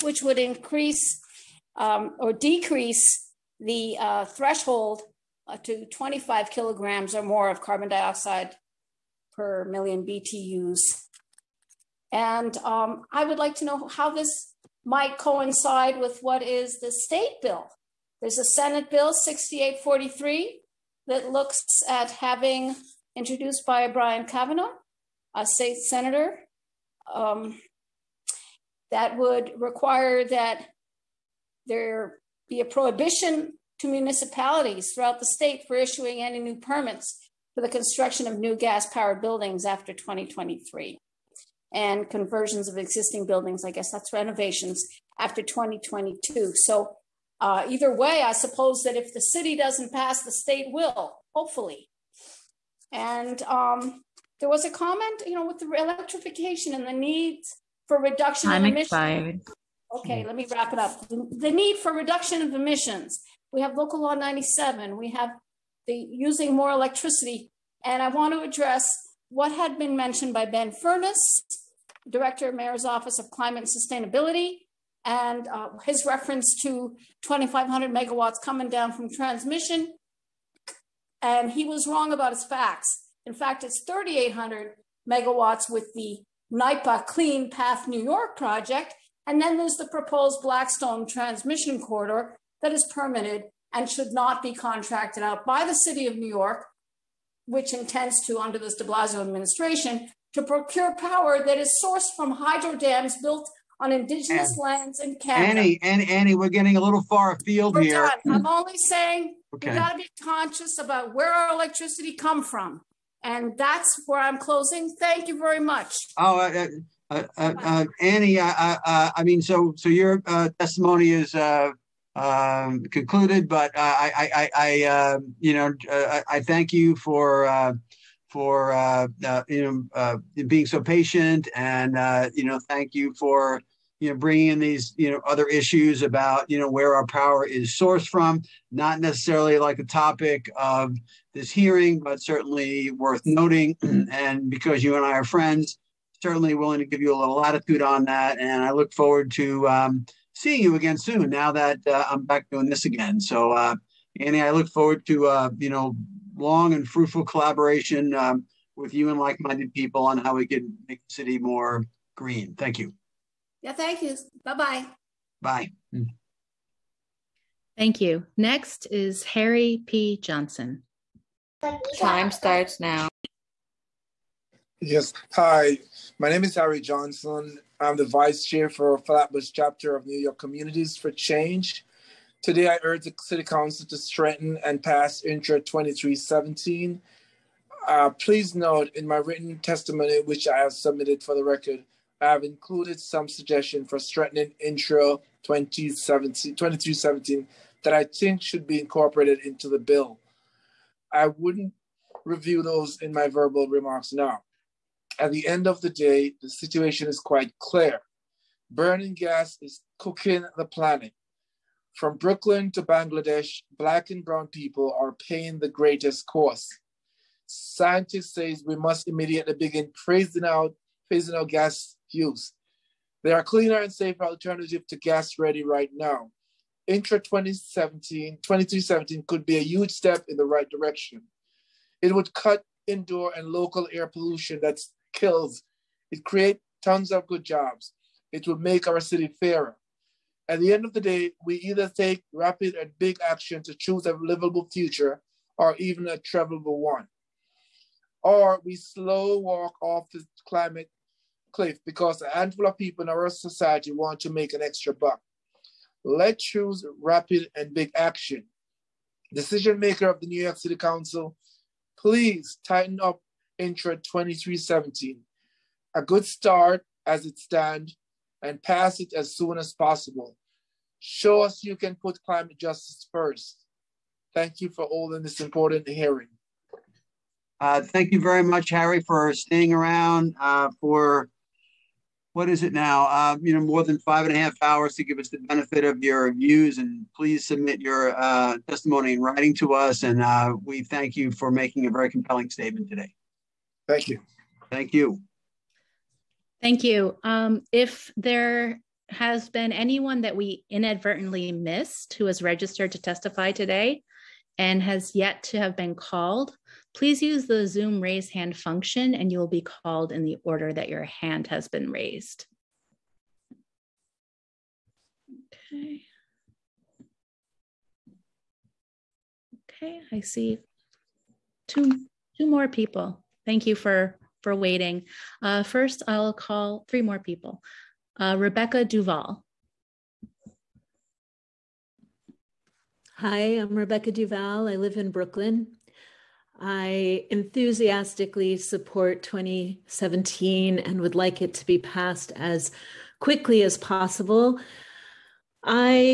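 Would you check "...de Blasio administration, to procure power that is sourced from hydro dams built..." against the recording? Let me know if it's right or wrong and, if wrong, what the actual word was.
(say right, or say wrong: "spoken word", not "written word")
right.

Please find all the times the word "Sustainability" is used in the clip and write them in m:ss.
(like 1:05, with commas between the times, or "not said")
1:14.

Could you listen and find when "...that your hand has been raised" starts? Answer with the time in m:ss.
5:10.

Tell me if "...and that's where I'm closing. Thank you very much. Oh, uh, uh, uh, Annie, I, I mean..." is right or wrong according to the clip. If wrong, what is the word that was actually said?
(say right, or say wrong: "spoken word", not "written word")
right.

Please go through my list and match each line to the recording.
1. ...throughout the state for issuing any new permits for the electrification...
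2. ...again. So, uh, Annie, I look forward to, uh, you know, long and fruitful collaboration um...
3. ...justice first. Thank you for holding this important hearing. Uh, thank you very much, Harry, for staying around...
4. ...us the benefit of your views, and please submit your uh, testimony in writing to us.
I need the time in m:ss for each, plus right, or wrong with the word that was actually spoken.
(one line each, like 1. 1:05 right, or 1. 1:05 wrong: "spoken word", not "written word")
1. 0:34 wrong: "construction", not "electrification"
2. 2:32 right
3. 4:32 right
4. 4:45 right.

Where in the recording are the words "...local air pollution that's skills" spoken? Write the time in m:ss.
3:53.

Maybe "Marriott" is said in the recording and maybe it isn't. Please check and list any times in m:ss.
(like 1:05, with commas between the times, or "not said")
not said.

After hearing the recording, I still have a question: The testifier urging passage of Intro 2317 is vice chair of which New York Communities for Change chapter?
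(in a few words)
Flatbush.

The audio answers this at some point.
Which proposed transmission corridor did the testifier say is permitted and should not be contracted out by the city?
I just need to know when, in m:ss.
1:30.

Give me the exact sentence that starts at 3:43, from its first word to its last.
There are cleaner and safer alternatives to gas ready right now.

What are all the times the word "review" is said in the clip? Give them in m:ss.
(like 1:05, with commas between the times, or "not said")
3:22.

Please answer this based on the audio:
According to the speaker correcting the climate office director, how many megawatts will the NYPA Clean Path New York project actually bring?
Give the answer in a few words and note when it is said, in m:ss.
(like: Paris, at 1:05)
3,800 megawatts, at 1:23.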